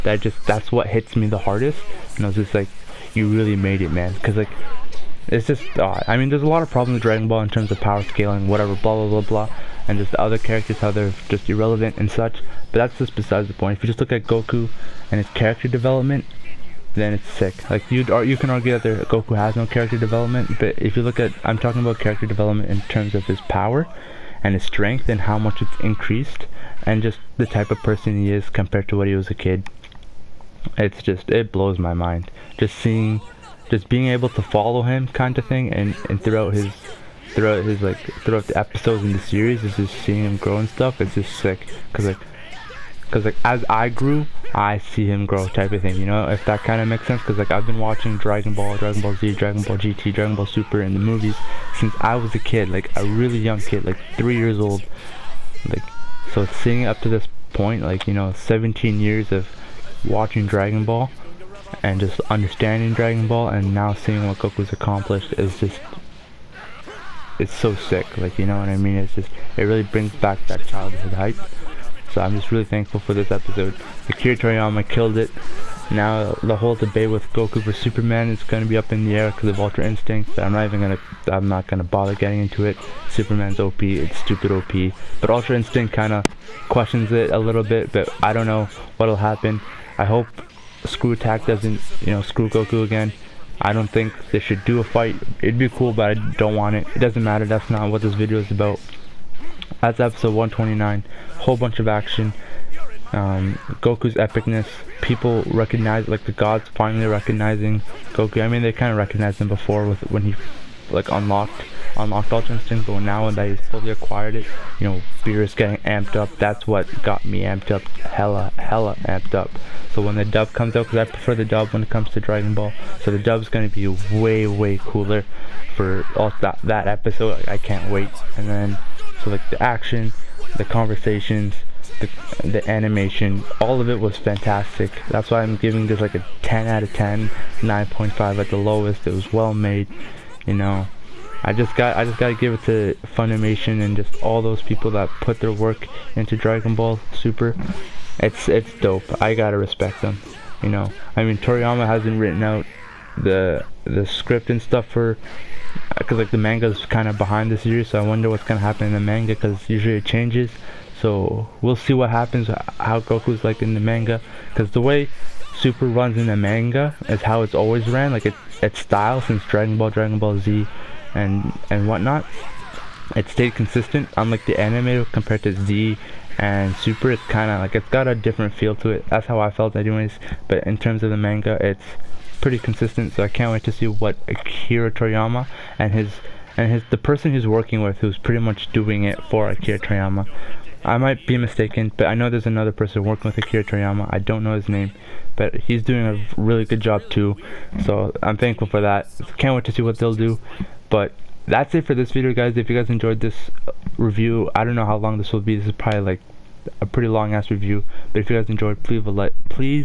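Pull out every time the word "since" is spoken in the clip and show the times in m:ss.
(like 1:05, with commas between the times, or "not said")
0:51, 2:49.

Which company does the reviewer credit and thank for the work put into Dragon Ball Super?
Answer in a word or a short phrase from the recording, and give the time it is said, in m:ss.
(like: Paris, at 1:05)
Funimation, at 2:23.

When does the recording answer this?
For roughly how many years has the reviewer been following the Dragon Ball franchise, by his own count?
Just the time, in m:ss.
0:58.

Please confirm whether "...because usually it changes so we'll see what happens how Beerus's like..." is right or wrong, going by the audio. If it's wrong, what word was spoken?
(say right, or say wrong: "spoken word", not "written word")
wrong: "Goku", not "Beerus".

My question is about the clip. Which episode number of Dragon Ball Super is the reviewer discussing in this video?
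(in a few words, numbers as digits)
129.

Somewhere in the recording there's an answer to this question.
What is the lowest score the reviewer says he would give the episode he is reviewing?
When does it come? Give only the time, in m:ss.
2:17.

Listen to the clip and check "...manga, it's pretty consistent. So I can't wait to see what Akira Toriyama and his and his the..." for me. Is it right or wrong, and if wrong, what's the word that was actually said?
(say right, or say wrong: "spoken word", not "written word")
right.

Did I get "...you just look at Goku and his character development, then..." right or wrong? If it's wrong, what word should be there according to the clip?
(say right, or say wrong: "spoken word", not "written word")
right.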